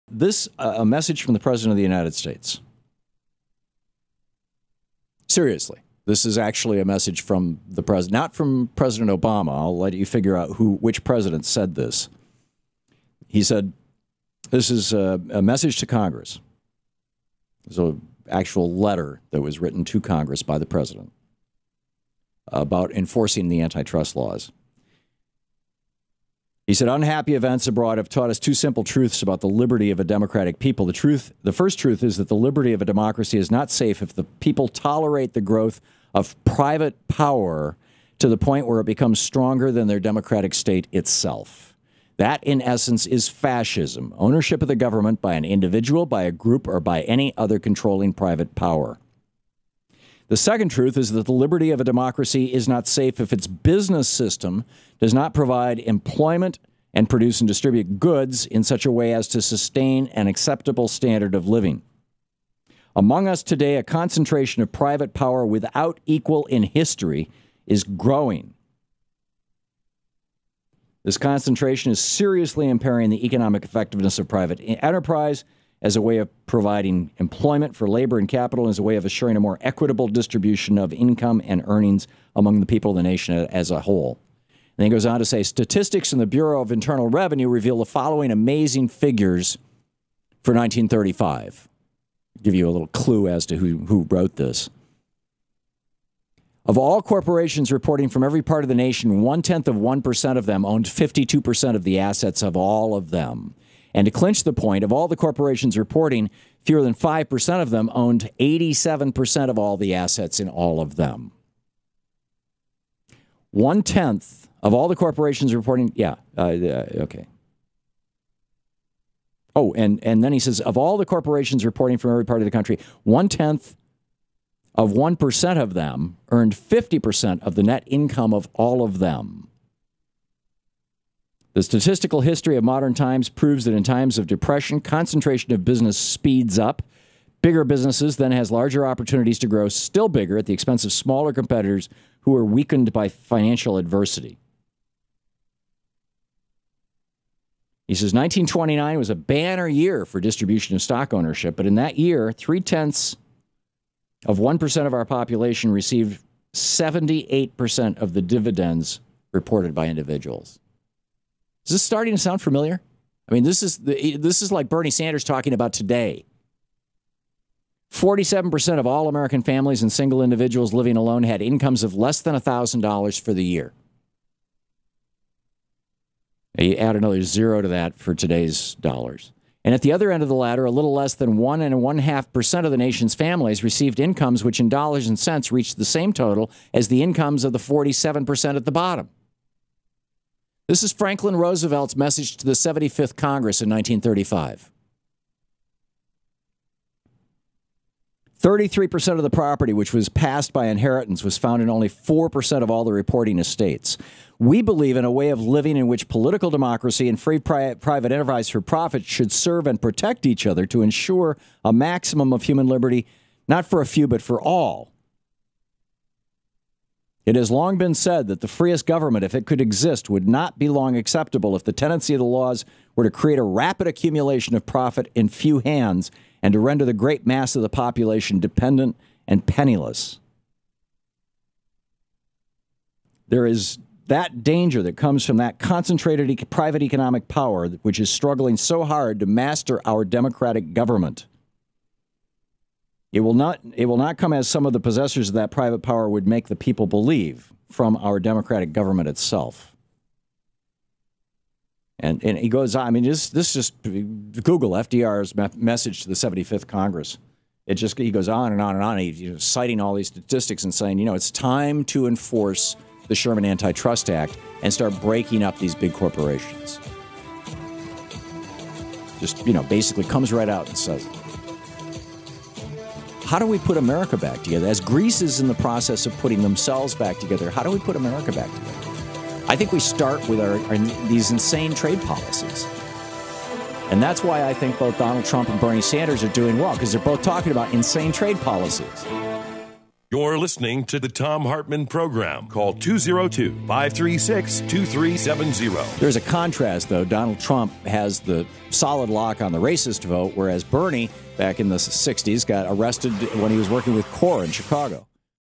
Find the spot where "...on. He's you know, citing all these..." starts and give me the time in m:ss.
4:18.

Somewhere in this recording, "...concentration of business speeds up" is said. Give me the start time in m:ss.
2:14.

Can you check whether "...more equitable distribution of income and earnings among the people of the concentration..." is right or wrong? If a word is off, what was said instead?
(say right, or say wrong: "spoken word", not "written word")
wrong: "nation", not "concentration".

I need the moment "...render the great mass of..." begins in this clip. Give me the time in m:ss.
3:46.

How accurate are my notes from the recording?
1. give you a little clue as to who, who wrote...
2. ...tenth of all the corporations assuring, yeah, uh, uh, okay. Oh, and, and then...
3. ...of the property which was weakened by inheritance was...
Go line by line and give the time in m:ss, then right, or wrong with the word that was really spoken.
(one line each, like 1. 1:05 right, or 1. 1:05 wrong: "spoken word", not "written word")
1. 1:32 right
2. 1:53 wrong: "reporting", not "assuring"
3. 3:19 wrong: "passed", not "weakened".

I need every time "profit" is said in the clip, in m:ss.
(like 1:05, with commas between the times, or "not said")
3:28, 3:44.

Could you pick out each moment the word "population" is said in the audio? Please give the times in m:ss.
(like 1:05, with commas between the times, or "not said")
2:35, 3:47.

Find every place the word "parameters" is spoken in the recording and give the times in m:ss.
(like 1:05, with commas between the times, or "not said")
not said.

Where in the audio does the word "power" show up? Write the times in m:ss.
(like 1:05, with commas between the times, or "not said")
0:37, 0:48, 1:05, 3:57, 4:05.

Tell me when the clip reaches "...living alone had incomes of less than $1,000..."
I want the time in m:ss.
2:50.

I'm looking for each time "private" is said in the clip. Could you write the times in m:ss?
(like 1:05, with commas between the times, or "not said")
0:36, 0:48, 1:04, 1:14, 3:27, 3:56, 4:05.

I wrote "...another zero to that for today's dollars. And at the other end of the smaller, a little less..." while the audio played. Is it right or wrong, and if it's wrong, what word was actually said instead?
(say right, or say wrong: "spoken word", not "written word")
wrong: "ladder", not "smaller".